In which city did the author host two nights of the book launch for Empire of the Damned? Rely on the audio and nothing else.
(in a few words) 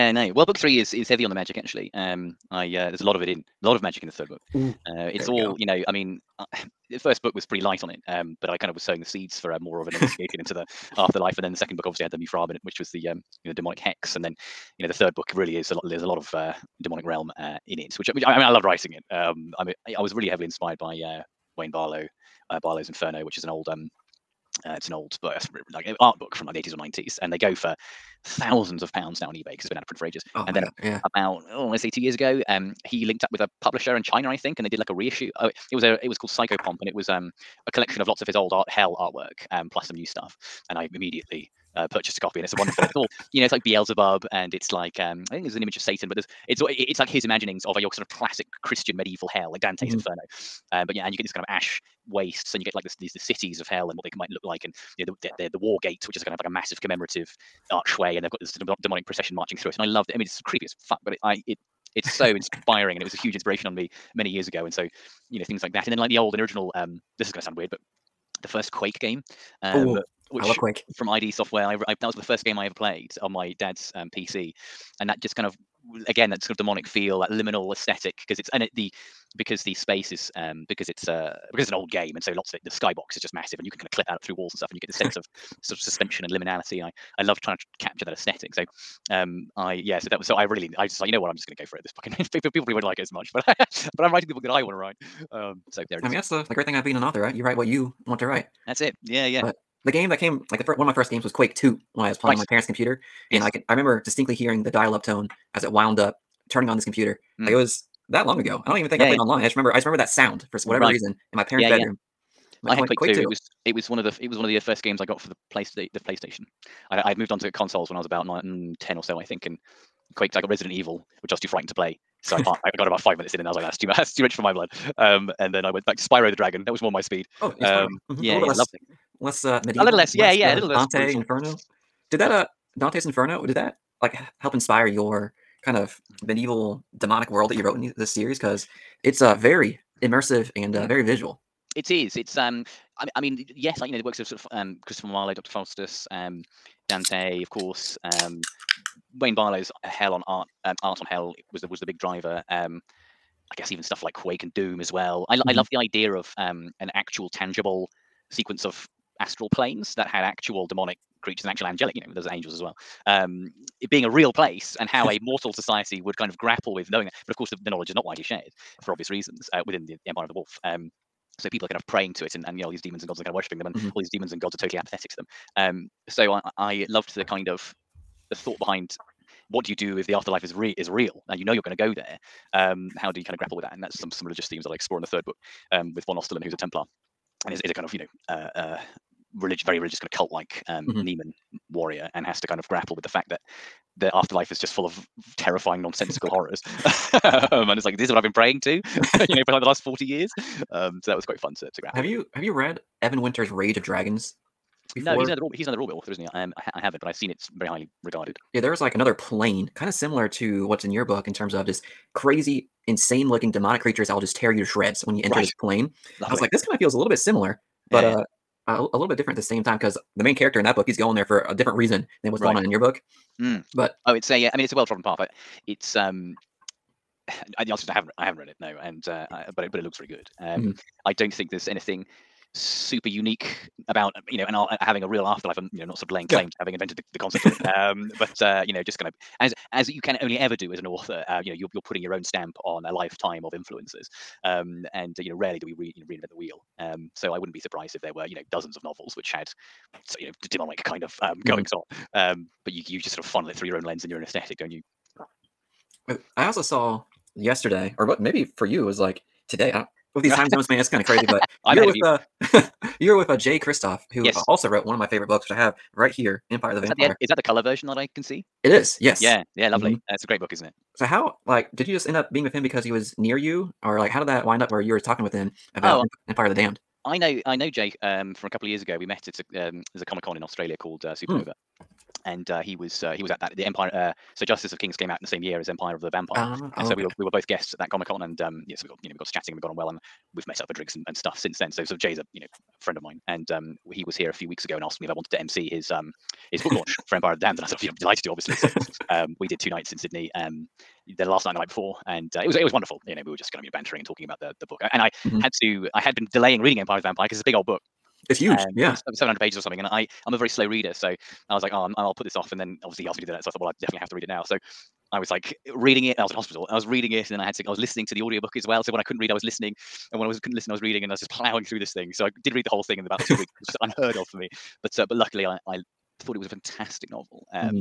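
Sydney.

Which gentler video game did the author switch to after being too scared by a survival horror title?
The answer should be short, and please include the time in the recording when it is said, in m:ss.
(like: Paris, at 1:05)
Spyro the Dragon, at 2:06.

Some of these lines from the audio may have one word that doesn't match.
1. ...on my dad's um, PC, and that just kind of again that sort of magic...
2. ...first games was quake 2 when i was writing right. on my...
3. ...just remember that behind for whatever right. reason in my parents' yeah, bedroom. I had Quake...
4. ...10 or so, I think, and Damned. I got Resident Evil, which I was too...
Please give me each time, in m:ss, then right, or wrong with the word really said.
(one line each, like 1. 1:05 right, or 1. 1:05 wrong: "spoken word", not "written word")
1. 1:13 wrong: "demonic", not "magic"
2. 1:40 wrong: "playing", not "writing"
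3. 1:49 wrong: "sound", not "behind"
4. 1:58 wrong: "Quake", not "Damned".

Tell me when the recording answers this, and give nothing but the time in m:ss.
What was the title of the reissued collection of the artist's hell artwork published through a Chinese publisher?
0:36.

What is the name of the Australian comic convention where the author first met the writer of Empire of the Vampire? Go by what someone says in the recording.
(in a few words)
Supernova.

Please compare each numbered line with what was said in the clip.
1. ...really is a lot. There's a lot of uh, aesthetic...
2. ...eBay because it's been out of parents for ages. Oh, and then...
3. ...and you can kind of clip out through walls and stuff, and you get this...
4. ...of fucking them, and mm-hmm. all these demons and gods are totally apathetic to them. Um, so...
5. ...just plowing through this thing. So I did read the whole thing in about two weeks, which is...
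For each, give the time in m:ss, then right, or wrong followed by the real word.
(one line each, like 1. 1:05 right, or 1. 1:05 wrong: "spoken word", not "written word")
1. 0:15 wrong: "demonic", not "aesthetic"
2. 0:29 wrong: "print", not "parents"
3. 1:23 right
4. 2:53 wrong: "worshipping", not "fucking"
5. 5:21 right.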